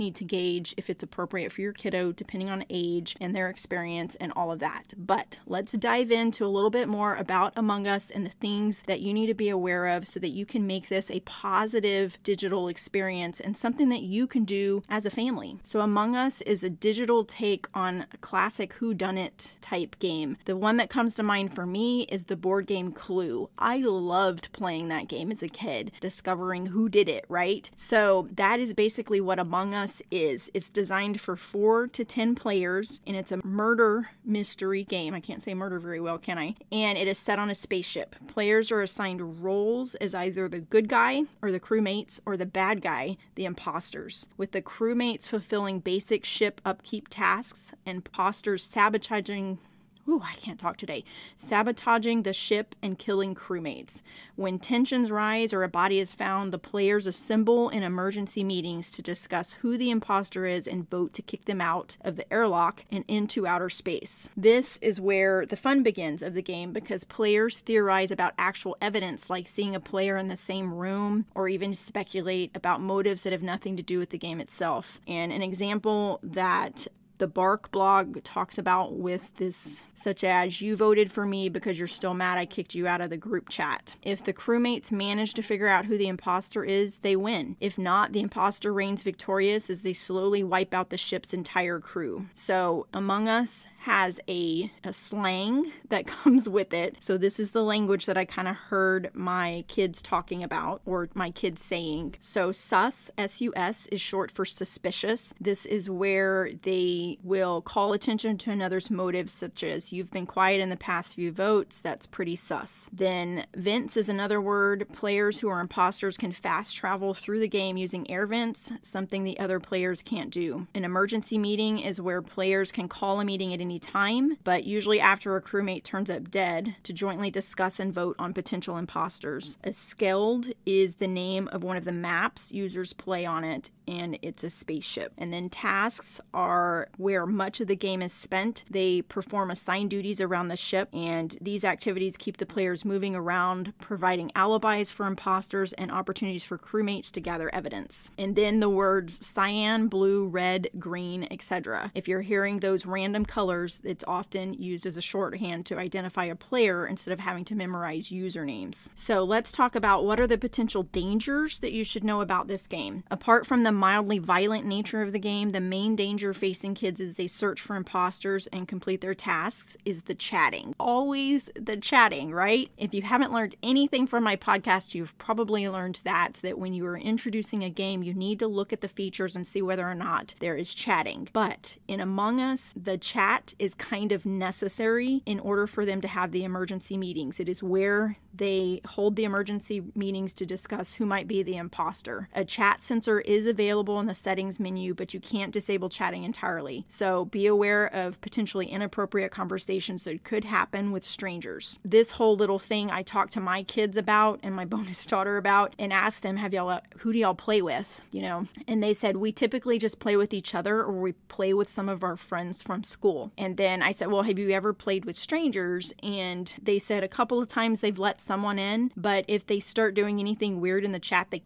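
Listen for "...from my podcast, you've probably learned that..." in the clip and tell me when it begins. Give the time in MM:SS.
02:54.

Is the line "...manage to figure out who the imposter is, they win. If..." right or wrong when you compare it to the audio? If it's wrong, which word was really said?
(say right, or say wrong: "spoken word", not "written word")
right.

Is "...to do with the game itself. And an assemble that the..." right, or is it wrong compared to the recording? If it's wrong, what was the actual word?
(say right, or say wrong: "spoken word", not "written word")
wrong: "example", not "assemble".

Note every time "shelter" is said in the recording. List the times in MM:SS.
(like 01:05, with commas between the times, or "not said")
not said.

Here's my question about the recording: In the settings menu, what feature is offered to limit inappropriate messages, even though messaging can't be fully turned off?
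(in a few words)
Chat censor.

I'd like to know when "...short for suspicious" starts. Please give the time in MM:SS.
01:44.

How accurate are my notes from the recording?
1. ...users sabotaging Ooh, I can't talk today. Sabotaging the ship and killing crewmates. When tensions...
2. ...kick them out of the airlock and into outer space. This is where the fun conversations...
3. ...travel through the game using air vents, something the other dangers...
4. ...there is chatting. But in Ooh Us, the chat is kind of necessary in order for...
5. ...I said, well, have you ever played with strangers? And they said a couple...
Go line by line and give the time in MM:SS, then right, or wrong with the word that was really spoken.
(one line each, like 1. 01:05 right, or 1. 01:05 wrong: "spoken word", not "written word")
1. 00:47 wrong: "imposters", not "users"
2. 01:01 wrong: "begins", not "conversations"
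3. 01:56 wrong: "players", not "dangers"
4. 03:00 wrong: "Among", not "Ooh"
5. 03:33 right.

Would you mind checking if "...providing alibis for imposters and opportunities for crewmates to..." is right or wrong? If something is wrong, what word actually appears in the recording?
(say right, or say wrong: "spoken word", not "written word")
right.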